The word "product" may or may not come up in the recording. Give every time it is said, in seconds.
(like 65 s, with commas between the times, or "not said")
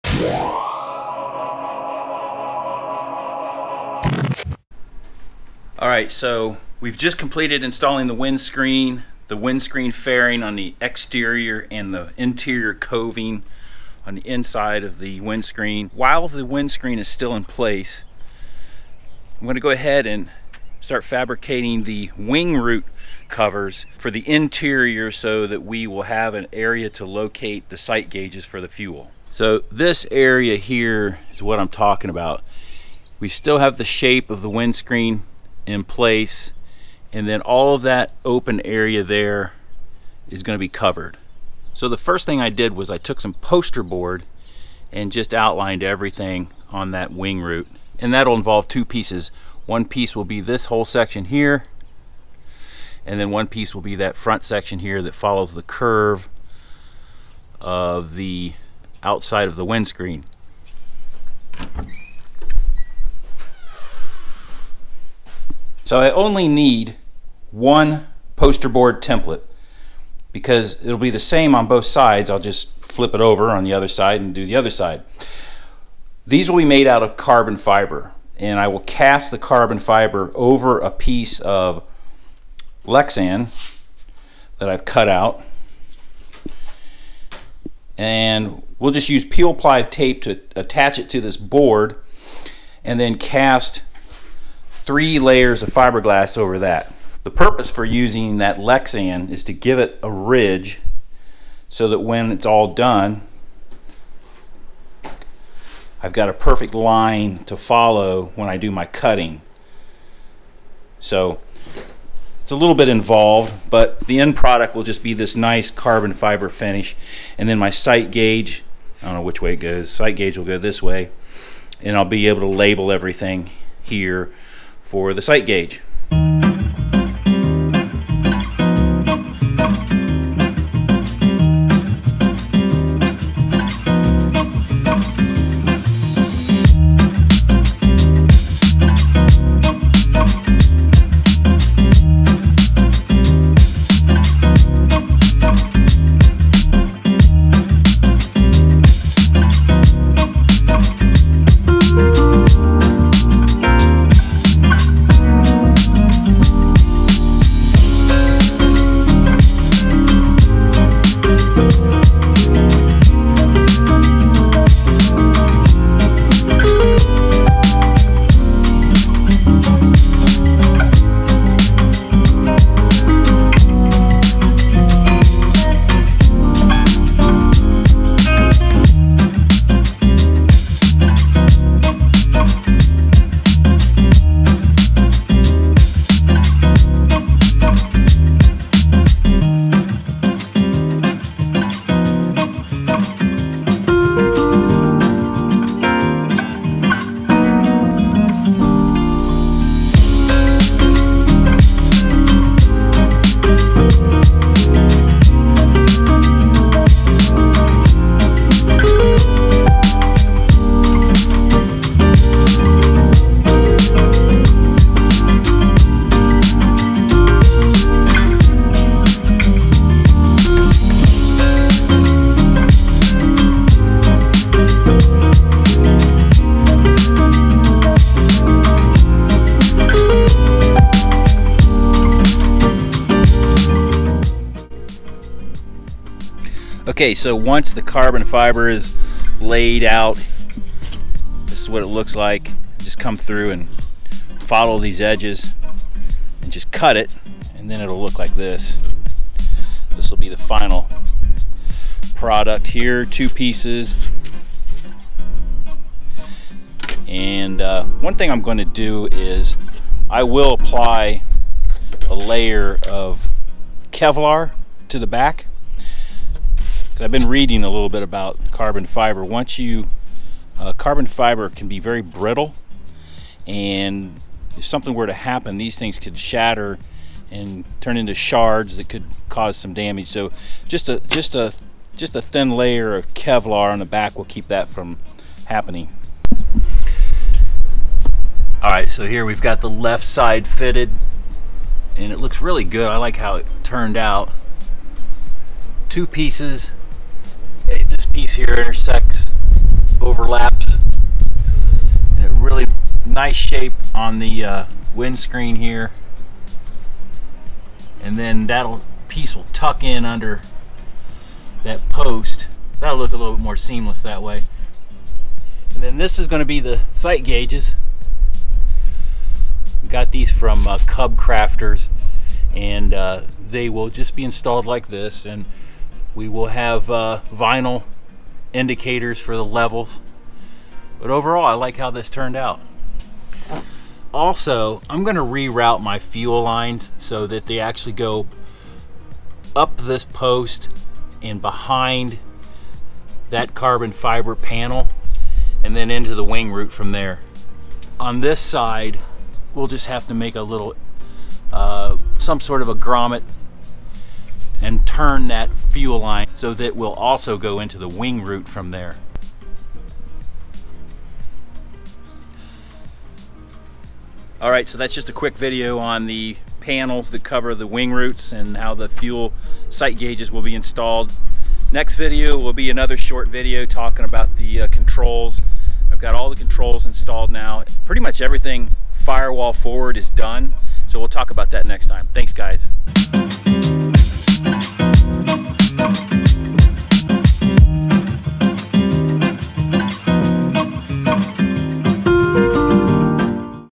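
114 s, 252 s.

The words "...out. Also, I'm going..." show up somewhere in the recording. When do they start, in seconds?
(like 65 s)
332 s.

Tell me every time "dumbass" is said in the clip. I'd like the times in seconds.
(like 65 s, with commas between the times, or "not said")
not said.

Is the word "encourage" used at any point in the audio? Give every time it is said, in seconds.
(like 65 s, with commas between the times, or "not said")
not said.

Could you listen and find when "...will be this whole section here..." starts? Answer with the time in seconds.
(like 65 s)
50 s.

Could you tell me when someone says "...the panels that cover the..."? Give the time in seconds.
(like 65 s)
366 s.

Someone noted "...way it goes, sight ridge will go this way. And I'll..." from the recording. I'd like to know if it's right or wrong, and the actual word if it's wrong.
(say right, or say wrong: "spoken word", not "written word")
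wrong: "gauge", not "ridge".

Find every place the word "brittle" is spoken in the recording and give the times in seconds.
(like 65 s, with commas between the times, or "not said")
272 s.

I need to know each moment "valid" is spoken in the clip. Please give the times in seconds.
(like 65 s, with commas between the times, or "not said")
not said.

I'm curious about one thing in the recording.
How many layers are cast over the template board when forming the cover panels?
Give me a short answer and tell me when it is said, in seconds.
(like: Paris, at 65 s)
3, at 94 s.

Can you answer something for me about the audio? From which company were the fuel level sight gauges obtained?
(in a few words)
Cub Crafters.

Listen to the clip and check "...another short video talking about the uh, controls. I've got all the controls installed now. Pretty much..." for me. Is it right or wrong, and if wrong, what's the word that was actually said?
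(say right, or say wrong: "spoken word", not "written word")
right.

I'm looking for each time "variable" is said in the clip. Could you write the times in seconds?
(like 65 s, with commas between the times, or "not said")
not said.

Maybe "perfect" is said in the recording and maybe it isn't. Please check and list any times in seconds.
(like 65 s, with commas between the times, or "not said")
106 s.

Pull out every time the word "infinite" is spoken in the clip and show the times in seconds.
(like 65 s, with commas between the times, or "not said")
not said.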